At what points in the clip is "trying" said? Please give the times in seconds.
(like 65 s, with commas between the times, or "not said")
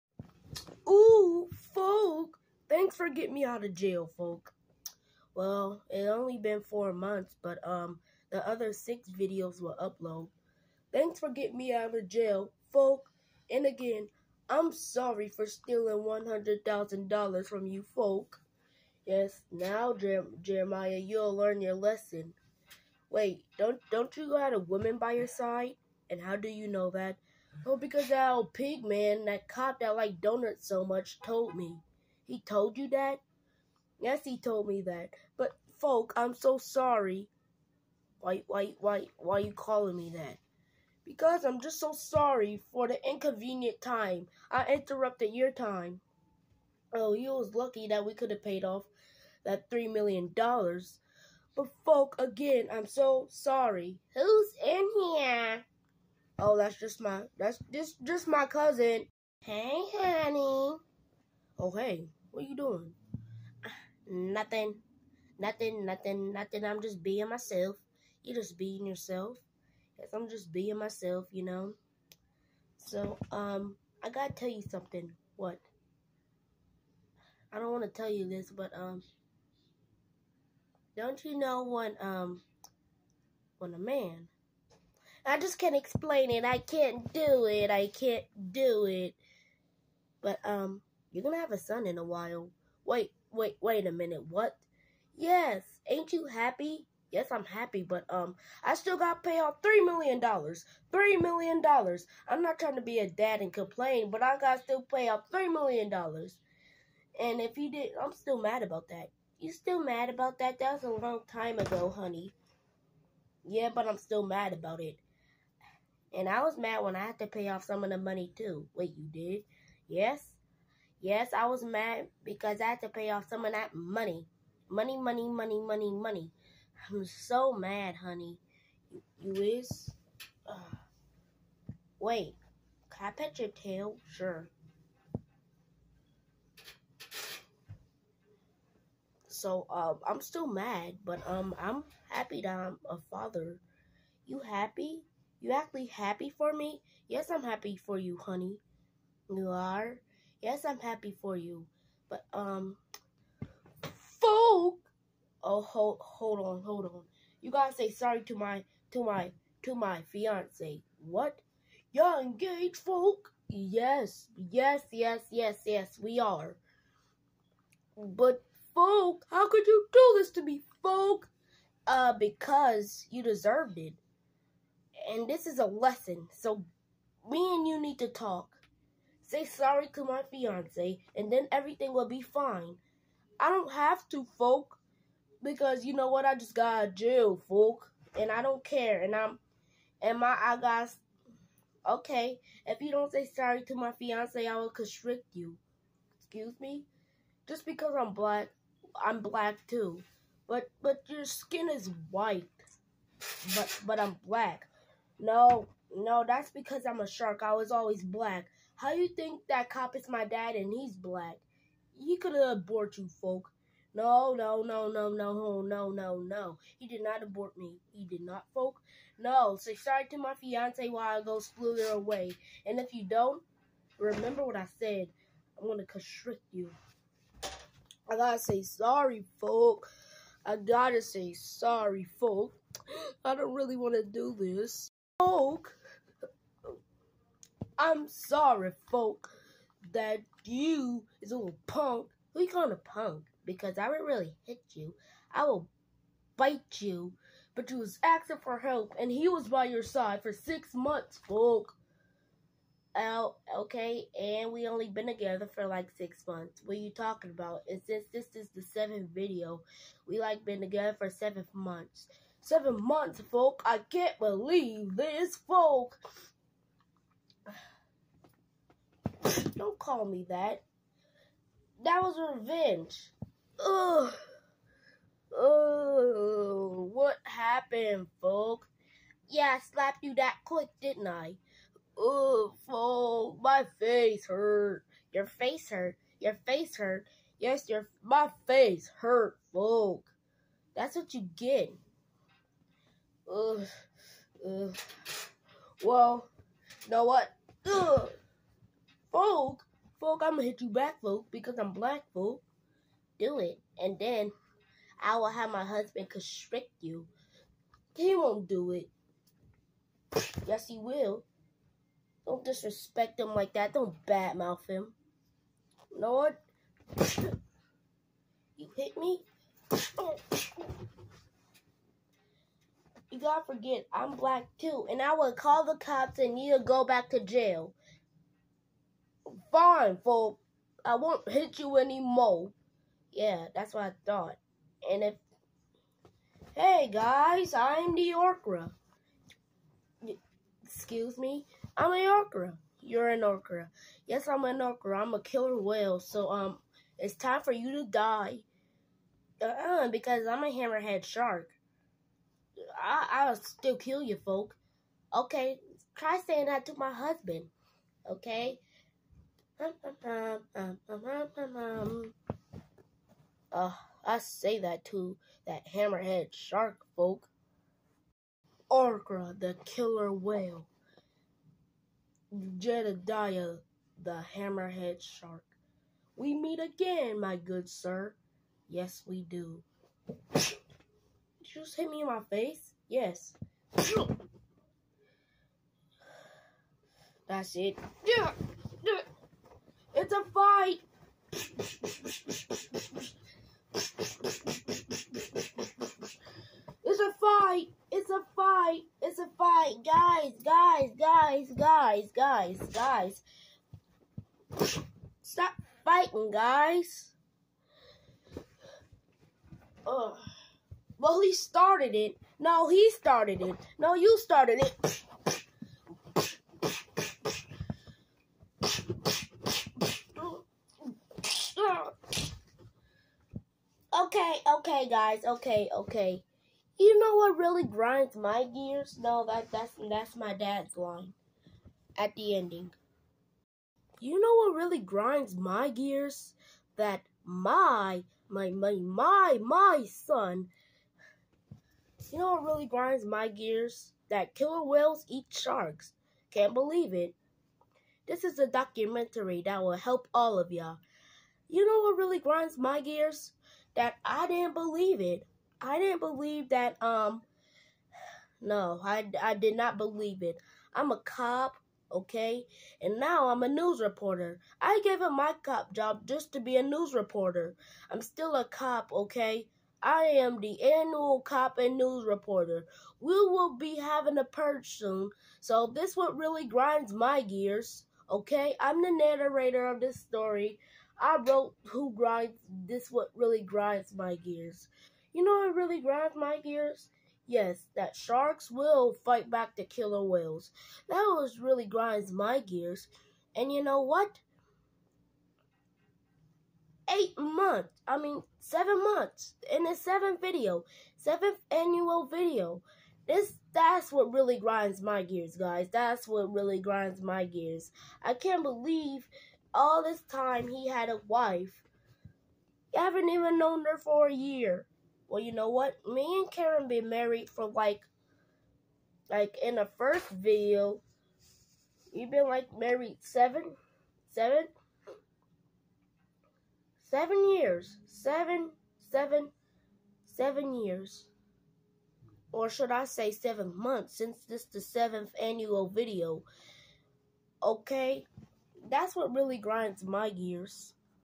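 102 s.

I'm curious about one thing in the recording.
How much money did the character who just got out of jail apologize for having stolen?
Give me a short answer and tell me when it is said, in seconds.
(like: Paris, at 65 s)
$100,000, at 16 s.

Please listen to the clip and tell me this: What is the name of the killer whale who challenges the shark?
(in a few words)
Orgra.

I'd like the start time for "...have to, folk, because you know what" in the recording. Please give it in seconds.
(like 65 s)
183 s.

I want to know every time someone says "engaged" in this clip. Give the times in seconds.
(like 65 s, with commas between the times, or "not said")
162 s.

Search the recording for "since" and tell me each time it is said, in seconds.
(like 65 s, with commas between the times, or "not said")
257 s, 533 s.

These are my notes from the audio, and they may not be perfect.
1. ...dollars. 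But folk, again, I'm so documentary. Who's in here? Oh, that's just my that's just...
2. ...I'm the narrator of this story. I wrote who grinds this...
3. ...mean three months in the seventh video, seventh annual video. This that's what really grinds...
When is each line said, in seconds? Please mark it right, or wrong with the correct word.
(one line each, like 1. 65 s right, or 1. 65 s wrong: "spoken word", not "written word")
1. 50 s wrong: "sorry", not "documentary"
2. 478 s right
3. 497 s wrong: "seven", not "three".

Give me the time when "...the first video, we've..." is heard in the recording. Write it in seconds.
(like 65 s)
519 s.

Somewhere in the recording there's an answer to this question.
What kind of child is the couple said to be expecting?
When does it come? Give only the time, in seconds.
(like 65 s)
91 s.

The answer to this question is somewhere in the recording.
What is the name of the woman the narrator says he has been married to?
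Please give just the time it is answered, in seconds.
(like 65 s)
516 s.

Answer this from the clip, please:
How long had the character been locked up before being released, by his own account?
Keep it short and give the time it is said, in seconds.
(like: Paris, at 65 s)
4 months, at 6 s.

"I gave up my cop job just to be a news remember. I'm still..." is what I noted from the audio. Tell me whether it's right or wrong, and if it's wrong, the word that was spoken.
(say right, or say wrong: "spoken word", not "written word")
wrong: "reporter", not "remember".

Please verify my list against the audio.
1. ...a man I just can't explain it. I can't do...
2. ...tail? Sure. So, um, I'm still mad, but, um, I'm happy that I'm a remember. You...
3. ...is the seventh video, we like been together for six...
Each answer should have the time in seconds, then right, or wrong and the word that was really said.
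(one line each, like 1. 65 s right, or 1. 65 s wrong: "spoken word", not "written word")
1. 83 s right
2. 133 s wrong: "father", not "remember"
3. 258 s wrong: "seven", not "six".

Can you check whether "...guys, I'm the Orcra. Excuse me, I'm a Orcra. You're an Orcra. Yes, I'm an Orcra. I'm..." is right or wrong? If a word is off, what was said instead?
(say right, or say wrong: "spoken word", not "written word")
right.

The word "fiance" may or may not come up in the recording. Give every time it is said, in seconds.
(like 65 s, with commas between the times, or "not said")
160 s, 180 s, 193 s, 220 s.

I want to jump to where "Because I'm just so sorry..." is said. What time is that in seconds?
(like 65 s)
41 s.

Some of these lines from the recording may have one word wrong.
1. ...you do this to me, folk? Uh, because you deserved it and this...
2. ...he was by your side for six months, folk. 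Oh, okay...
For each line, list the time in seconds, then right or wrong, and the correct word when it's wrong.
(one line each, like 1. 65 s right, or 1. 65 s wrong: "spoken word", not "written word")
1. 169 s right
2. 249 s right.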